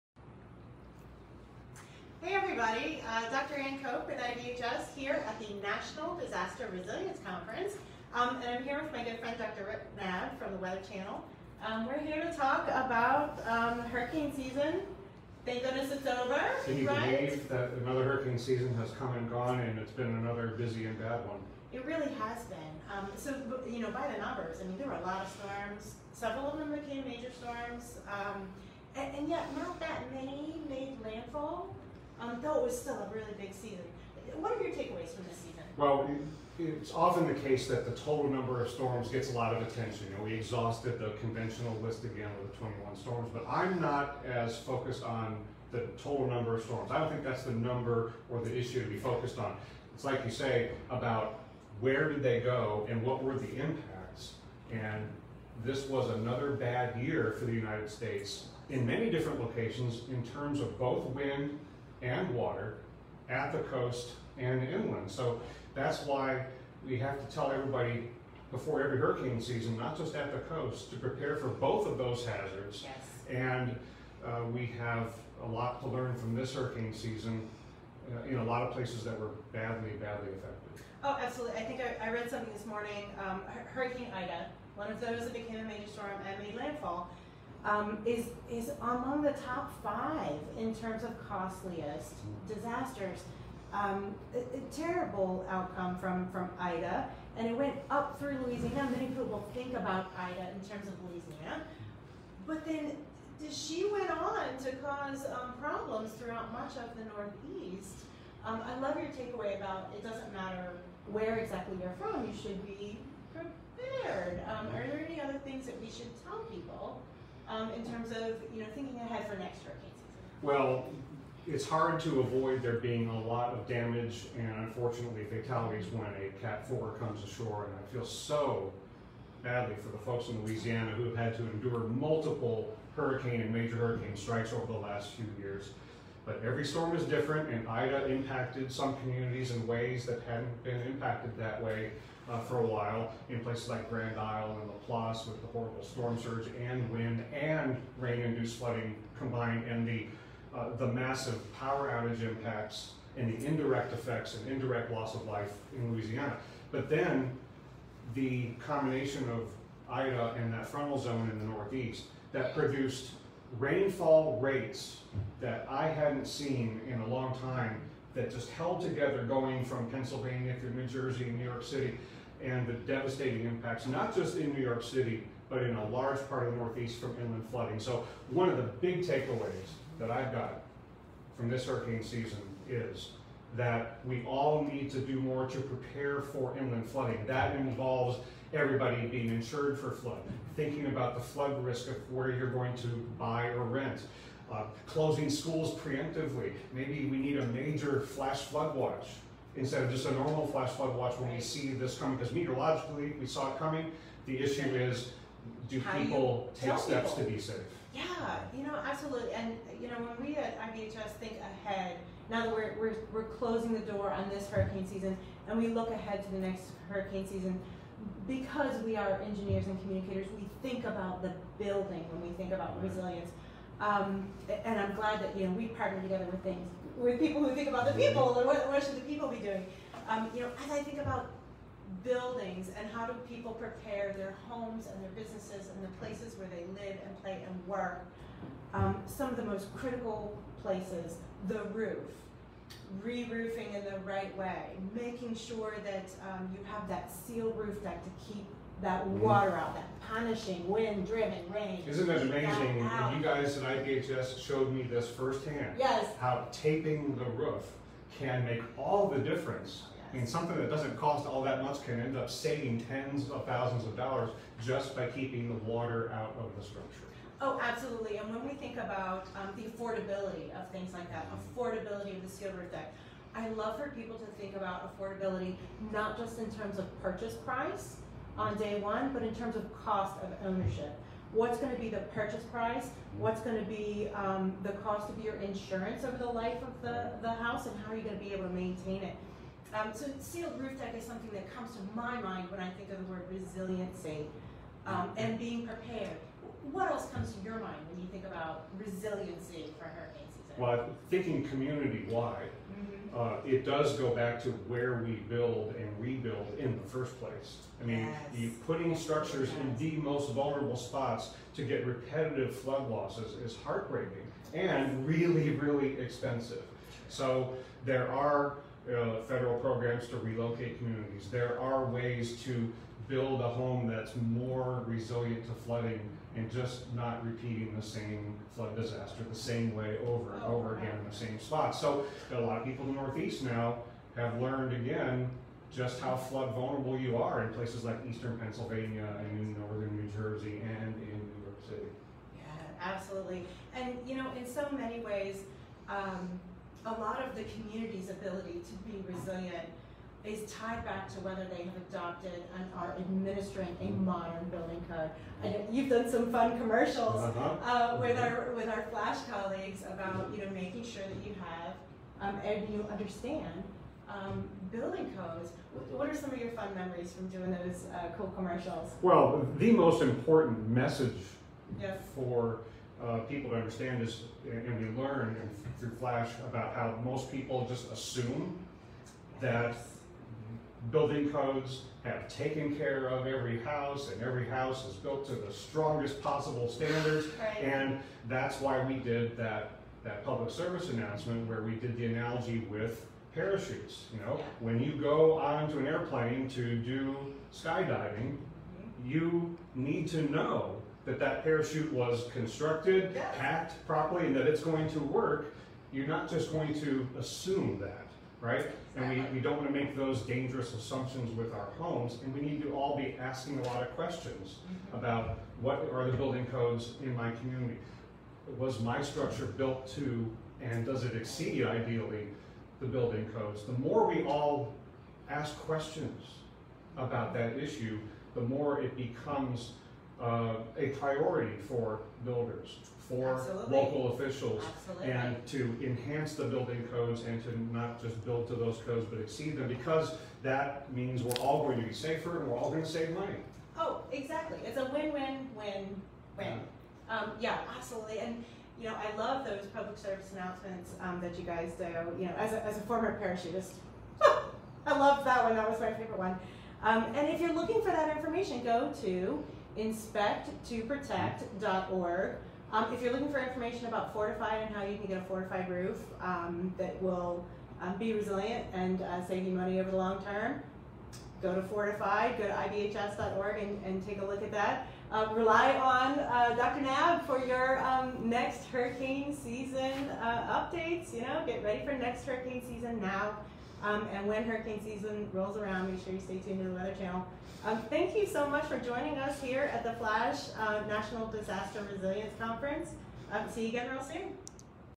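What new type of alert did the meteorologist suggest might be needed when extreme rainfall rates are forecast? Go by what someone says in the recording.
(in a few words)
Major flash flood watch.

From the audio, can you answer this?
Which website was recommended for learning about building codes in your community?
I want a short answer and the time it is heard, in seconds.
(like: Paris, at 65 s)
inspecttoprotect.org, at 459 s.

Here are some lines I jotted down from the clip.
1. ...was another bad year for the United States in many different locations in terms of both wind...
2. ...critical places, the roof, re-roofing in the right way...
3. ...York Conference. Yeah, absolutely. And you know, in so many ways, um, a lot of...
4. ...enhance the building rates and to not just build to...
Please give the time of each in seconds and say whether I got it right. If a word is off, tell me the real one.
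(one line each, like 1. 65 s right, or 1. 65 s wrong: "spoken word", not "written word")
1. 55 s right
2. 239 s right
3. 341 s wrong: "City", not "Conference"
4. 435 s wrong: "codes", not "rates".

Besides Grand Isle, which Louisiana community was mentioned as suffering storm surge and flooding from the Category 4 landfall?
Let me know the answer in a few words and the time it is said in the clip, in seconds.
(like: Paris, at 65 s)
Laplace, at 144 s.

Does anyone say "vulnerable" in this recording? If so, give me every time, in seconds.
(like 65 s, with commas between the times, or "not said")
310 s, 336 s.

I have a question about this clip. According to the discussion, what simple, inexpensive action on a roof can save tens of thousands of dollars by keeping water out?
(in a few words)
Taping the roof.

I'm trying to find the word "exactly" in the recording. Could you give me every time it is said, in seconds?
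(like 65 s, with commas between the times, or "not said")
111 s, 444 s.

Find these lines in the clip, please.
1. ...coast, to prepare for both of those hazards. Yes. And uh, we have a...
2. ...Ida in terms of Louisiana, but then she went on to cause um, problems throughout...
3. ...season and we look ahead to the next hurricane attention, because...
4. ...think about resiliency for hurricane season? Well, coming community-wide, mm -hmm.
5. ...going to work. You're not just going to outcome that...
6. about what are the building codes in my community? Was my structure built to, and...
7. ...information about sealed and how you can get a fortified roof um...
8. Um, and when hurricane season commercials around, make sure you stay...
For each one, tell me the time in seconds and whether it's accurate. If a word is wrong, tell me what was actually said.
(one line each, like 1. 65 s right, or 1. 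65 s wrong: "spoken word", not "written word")
1. 70 s right
2. 100 s right
3. 214 s wrong: "season", not "attention"
4. 298 s wrong: "thinking", not "coming"
5. 404 s wrong: "assume", not "outcome"
6. 414 s right
7. 463 s wrong: "fortified", not "sealed"
8. 483 s wrong: "rolls", not "commercials".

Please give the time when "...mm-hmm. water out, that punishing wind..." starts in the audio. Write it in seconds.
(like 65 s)
249 s.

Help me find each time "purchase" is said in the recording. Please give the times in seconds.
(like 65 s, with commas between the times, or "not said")
277 s, 282 s.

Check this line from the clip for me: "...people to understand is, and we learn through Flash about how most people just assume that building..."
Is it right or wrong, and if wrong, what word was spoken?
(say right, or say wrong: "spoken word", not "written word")
right.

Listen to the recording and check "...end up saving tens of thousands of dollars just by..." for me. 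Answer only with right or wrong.
right.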